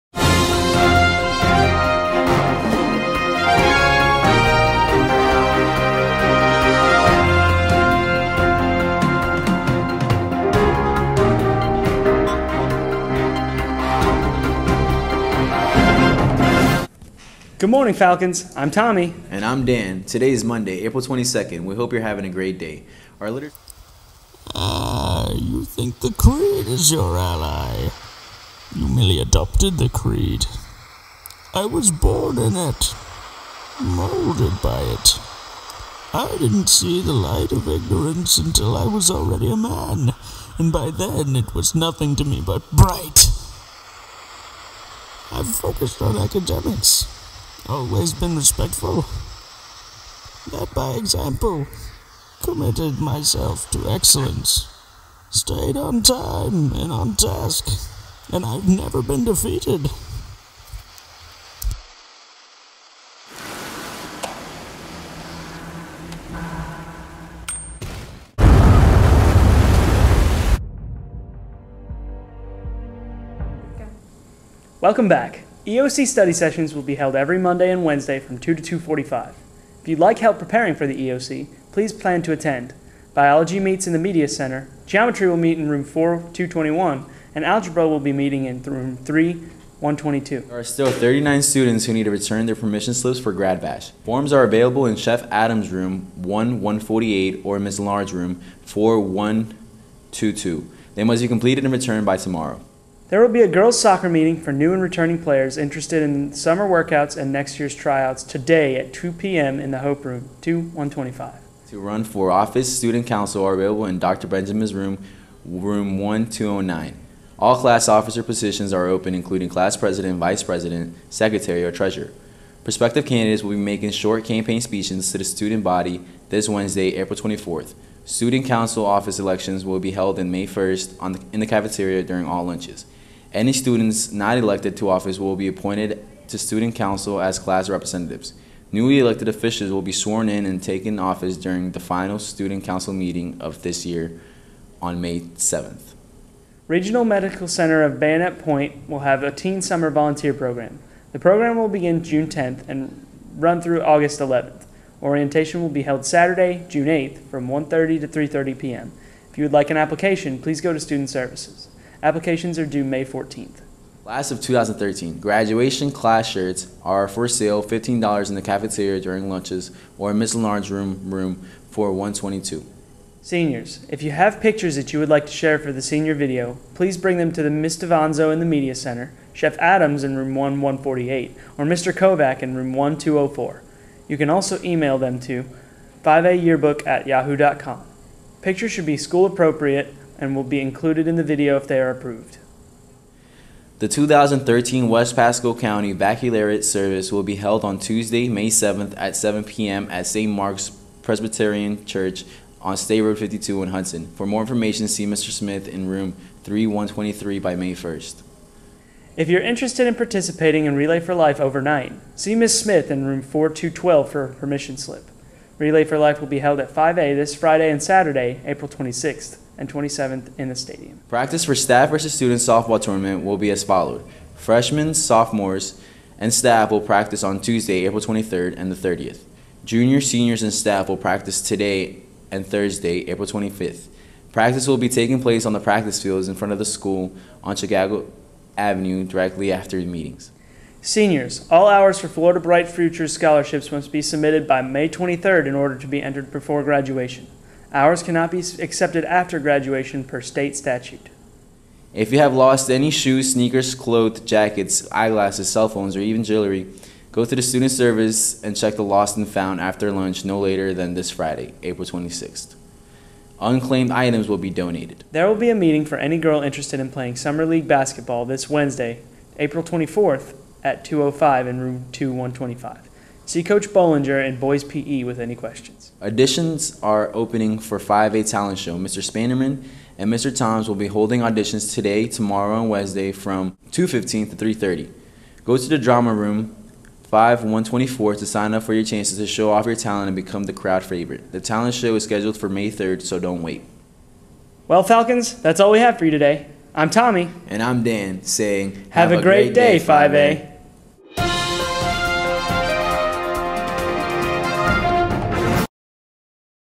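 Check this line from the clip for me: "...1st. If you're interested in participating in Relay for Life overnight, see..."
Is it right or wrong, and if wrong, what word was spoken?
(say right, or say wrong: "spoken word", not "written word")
right.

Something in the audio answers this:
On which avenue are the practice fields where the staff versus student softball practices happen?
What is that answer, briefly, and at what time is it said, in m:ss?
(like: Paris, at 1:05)
Chicago Avenue, at 3:57.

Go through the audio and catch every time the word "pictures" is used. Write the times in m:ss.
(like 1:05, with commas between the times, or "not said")
2:54, 3:08.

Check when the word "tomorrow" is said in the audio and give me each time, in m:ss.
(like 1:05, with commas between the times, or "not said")
1:42, 4:42.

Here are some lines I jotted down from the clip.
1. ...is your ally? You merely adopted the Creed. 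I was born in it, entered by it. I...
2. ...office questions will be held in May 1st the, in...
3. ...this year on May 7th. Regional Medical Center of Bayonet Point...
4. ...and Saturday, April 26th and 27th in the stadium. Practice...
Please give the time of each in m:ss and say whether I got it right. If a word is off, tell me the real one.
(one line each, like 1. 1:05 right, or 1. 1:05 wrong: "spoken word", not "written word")
1. 0:26 wrong: "molded", not "entered"
2. 2:08 wrong: "elections", not "questions"
3. 2:23 right
4. 3:37 right.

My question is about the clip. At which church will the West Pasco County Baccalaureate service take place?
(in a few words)
St. Mark's Presbyterian Church.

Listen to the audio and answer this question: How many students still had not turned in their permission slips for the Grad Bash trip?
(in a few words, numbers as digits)
39.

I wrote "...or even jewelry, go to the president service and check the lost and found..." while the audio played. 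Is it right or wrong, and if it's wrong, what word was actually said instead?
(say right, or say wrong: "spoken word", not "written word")
wrong: "student", not "president".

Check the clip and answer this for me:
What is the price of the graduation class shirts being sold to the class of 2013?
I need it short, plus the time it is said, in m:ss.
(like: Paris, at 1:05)
$15, at 2:47.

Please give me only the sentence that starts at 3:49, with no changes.
Junior, seniors, and staff will practice today and Thursday, April 25th.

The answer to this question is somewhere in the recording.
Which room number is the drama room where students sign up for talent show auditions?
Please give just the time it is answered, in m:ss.
4:47.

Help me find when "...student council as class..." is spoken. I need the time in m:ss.
2:16.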